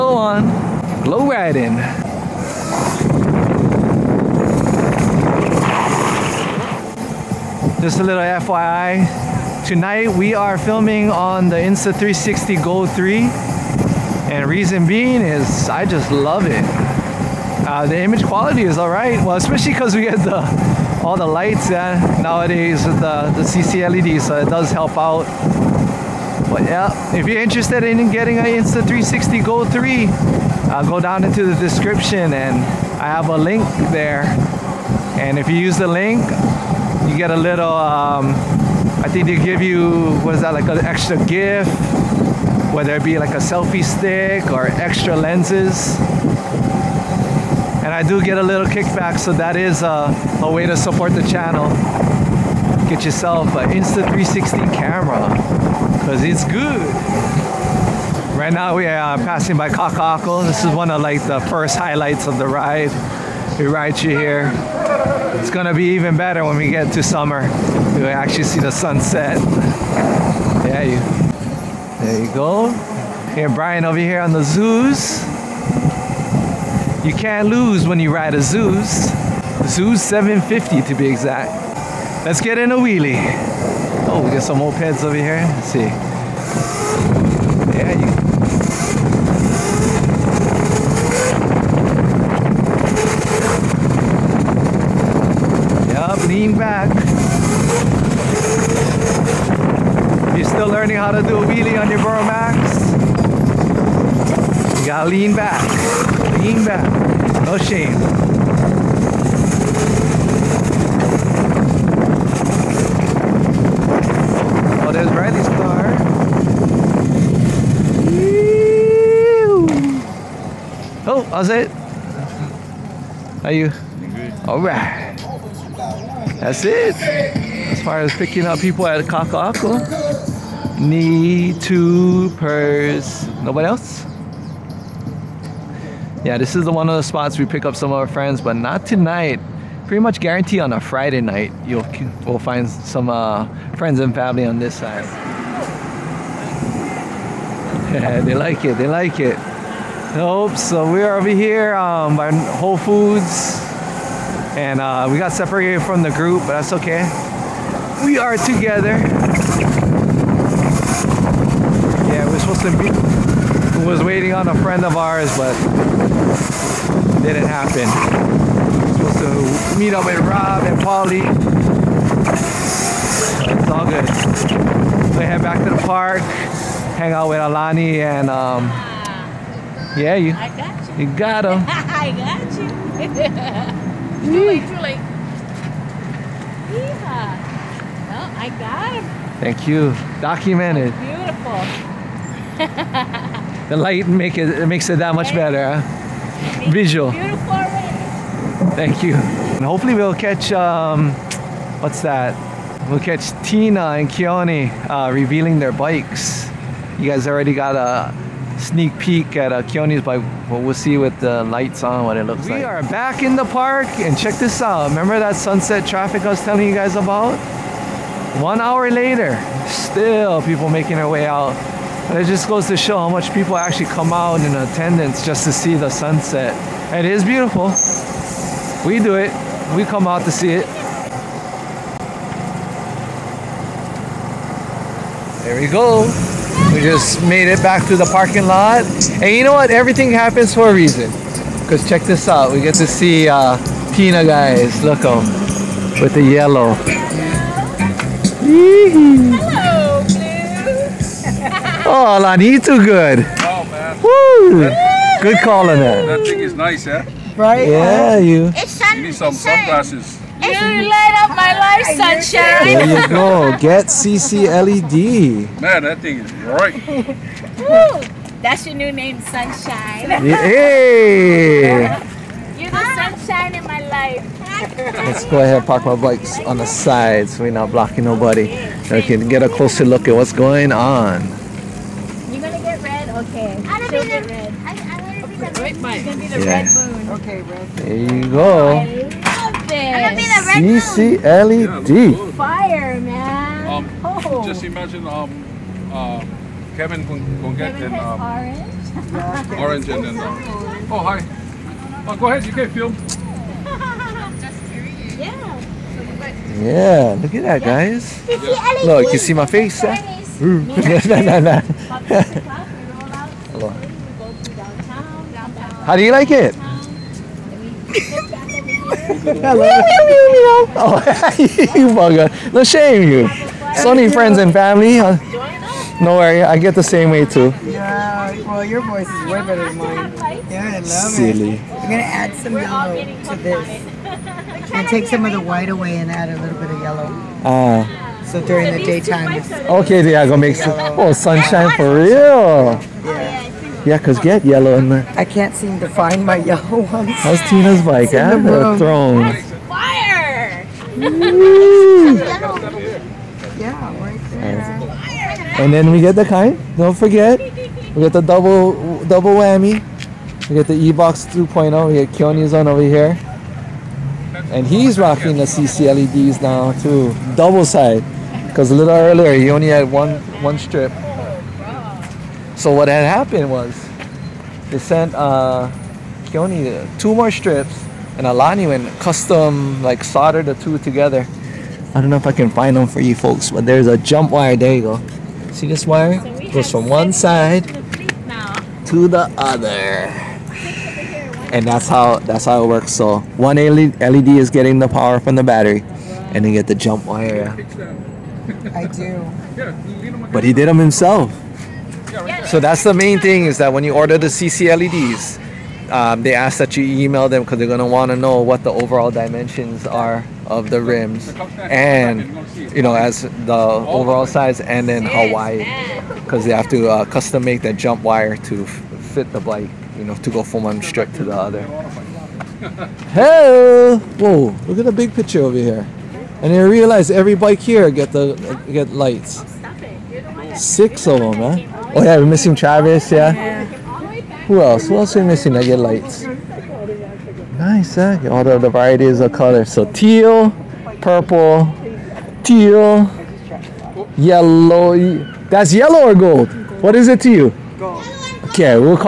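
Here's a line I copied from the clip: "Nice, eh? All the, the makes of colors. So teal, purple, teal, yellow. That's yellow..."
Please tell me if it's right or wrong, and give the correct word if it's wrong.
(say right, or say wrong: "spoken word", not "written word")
wrong: "varieties", not "makes".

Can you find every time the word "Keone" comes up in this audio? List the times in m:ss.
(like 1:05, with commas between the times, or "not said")
3:24, 3:29, 6:02.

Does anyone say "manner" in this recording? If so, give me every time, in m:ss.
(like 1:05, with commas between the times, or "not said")
not said.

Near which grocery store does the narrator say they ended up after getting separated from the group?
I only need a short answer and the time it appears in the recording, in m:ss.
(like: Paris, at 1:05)
Whole Foods, at 2:32.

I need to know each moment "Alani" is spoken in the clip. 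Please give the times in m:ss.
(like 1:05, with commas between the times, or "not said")
2:57, 6:18.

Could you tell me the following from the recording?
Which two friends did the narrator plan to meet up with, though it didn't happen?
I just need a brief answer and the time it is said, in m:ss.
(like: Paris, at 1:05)
Rob and Polly, at 2:50.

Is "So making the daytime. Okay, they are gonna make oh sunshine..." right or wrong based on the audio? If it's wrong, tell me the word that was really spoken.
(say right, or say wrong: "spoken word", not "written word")
wrong: "during", not "making".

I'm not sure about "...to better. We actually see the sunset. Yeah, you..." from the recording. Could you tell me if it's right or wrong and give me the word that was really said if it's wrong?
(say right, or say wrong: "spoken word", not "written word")
wrong: "summer", not "better".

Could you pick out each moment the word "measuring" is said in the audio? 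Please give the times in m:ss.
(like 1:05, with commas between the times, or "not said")
not said.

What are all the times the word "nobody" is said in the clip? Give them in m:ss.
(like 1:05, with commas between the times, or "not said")
2:13, 4:38.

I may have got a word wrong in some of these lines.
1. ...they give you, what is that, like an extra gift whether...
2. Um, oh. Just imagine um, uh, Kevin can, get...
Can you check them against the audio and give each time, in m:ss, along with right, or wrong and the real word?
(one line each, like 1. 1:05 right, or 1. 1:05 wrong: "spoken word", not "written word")
1. 0:39 right
2. 4:53 right.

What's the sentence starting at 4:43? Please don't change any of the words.
I, I want to going to be the red moon.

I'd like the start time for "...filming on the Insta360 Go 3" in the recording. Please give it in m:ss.
0:10.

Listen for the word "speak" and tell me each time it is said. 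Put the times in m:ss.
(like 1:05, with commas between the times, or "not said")
not said.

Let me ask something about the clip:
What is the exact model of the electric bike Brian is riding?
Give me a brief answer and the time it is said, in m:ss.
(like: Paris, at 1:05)
Zooz 750, at 1:19.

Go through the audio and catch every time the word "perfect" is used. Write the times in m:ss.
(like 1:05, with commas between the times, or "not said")
not said.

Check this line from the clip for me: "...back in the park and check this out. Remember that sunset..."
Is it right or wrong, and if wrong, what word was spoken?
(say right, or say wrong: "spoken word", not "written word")
right.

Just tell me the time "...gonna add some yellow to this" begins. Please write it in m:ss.
5:31.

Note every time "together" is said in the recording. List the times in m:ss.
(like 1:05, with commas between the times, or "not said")
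2:38, 6:20.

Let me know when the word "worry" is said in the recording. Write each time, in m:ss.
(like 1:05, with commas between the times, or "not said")
5:26.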